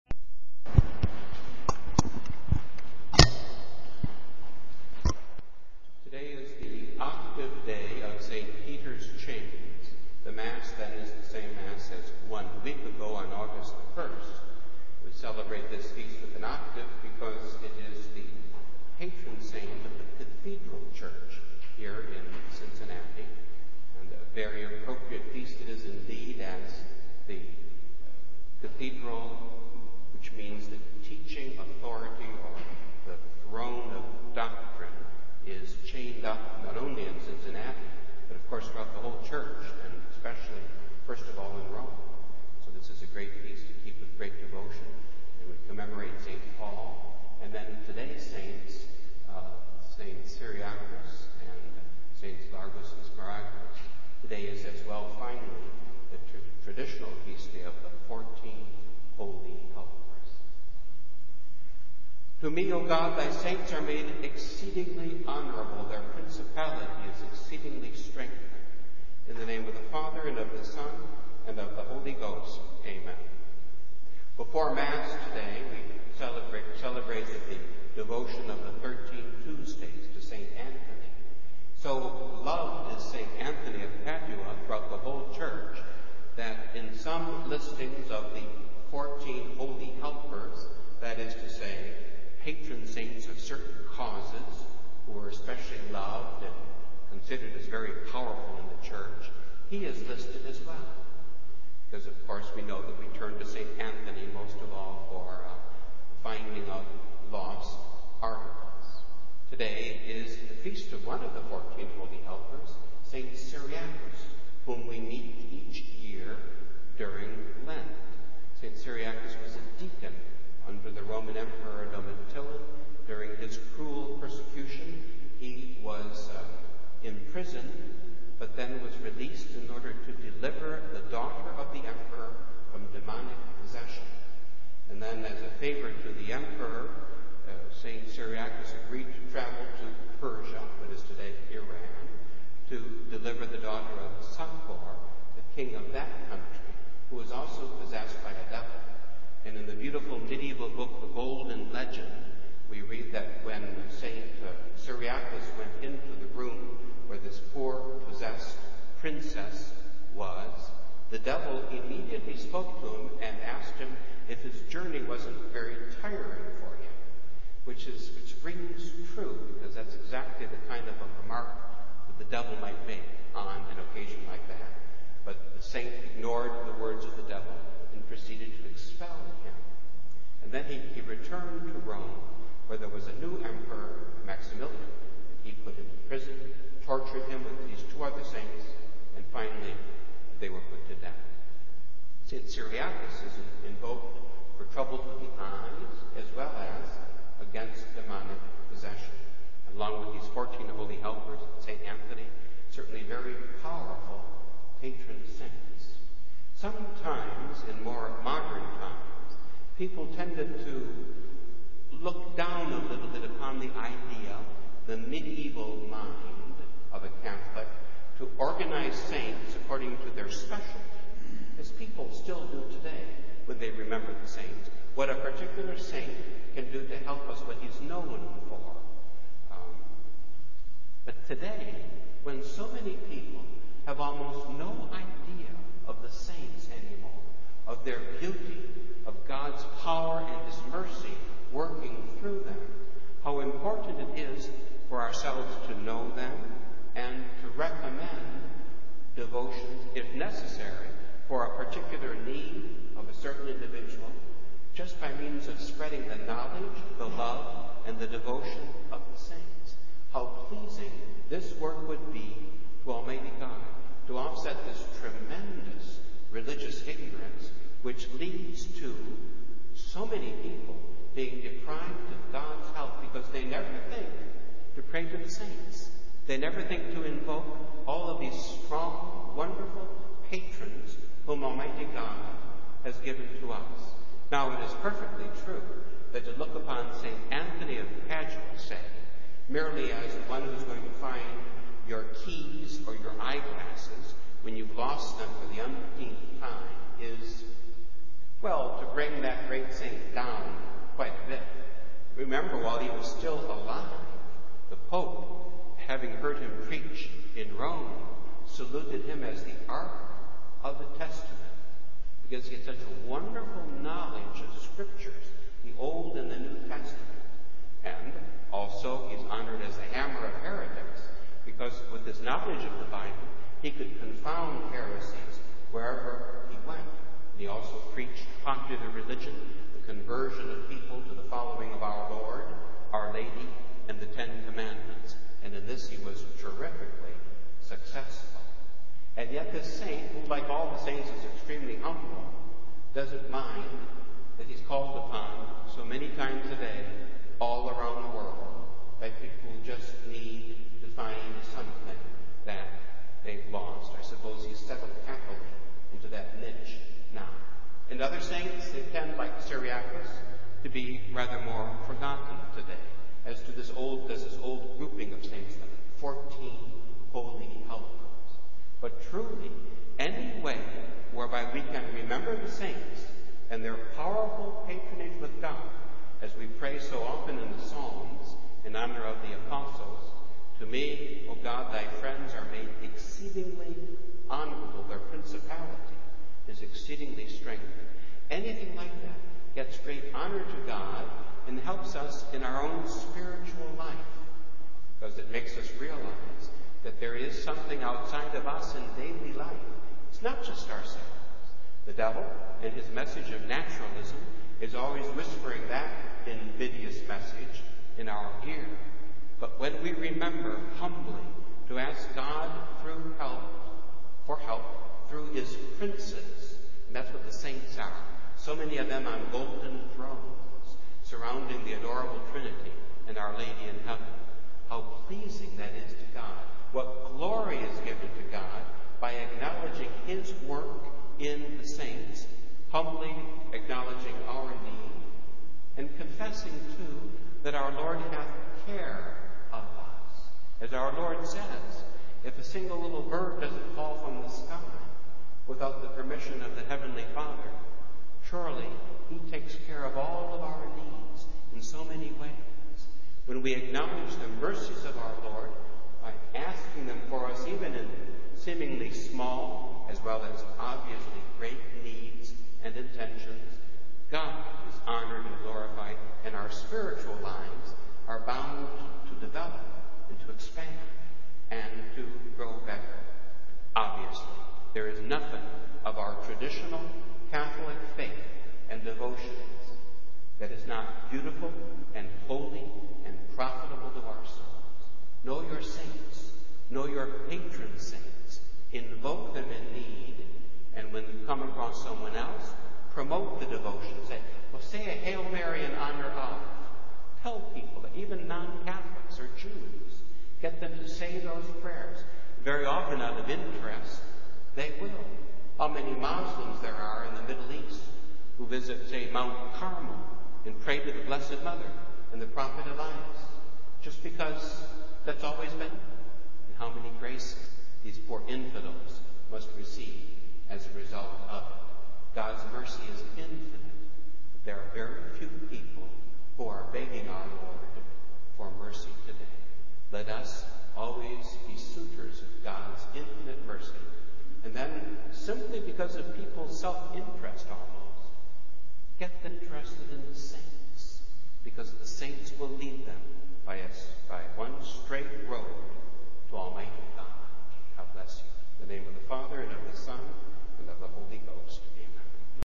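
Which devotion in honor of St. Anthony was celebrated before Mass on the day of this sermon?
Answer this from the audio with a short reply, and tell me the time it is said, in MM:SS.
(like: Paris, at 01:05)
13 Tuesdays, at 01:18.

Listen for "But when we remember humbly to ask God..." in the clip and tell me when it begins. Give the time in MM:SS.
06:49.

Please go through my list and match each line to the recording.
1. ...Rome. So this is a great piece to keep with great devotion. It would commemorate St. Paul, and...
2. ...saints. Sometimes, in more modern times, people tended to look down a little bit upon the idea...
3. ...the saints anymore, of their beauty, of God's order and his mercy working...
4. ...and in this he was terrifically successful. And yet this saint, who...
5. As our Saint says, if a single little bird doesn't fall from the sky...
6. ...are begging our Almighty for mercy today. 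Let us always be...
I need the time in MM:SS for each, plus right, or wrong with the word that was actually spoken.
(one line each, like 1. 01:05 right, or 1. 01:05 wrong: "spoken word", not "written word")
1. 00:41 right
2. 03:25 right
3. 03:56 wrong: "power", not "order"
4. 05:35 right
5. 07:20 wrong: "Lord", not "Saint"
6. 08:46 wrong: "Lord", not "Almighty".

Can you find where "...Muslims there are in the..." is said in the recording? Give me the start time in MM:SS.
08:25.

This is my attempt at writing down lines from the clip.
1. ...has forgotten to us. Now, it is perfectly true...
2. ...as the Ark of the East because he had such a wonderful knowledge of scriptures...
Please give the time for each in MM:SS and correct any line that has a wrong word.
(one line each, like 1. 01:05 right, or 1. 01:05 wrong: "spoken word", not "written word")
1. 04:42 wrong: "given", not "forgotten"
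2. 05:09 wrong: "Testament", not "East".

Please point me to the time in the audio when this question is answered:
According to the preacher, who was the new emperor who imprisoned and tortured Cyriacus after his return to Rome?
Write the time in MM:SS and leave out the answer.
03:04.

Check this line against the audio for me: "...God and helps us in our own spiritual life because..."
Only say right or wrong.
right.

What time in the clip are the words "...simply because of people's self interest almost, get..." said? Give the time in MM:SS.
08:55.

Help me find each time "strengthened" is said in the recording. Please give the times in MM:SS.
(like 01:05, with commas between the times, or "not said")
01:07, 06:27.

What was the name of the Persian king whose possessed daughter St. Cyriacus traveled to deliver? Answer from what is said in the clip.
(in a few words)
Sakor.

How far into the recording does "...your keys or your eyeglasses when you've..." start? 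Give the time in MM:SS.
04:51.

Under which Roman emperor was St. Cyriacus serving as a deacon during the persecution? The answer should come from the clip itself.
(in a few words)
Domitian.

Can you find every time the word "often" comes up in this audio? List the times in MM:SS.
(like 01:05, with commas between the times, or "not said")
06:17, 08:22.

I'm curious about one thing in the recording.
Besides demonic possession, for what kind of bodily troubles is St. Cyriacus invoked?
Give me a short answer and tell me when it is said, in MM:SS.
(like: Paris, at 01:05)
Eyes, at 03:15.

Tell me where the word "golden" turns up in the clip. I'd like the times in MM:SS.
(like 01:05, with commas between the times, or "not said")
02:31, 06:59.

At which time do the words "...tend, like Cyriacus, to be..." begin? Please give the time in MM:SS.
05:58.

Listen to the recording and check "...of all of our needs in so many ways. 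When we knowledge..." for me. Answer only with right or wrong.
wrong.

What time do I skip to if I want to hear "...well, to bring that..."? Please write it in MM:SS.
04:58.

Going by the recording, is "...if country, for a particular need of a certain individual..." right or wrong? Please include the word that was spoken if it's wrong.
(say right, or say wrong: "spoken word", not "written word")
wrong: "necessary", not "country".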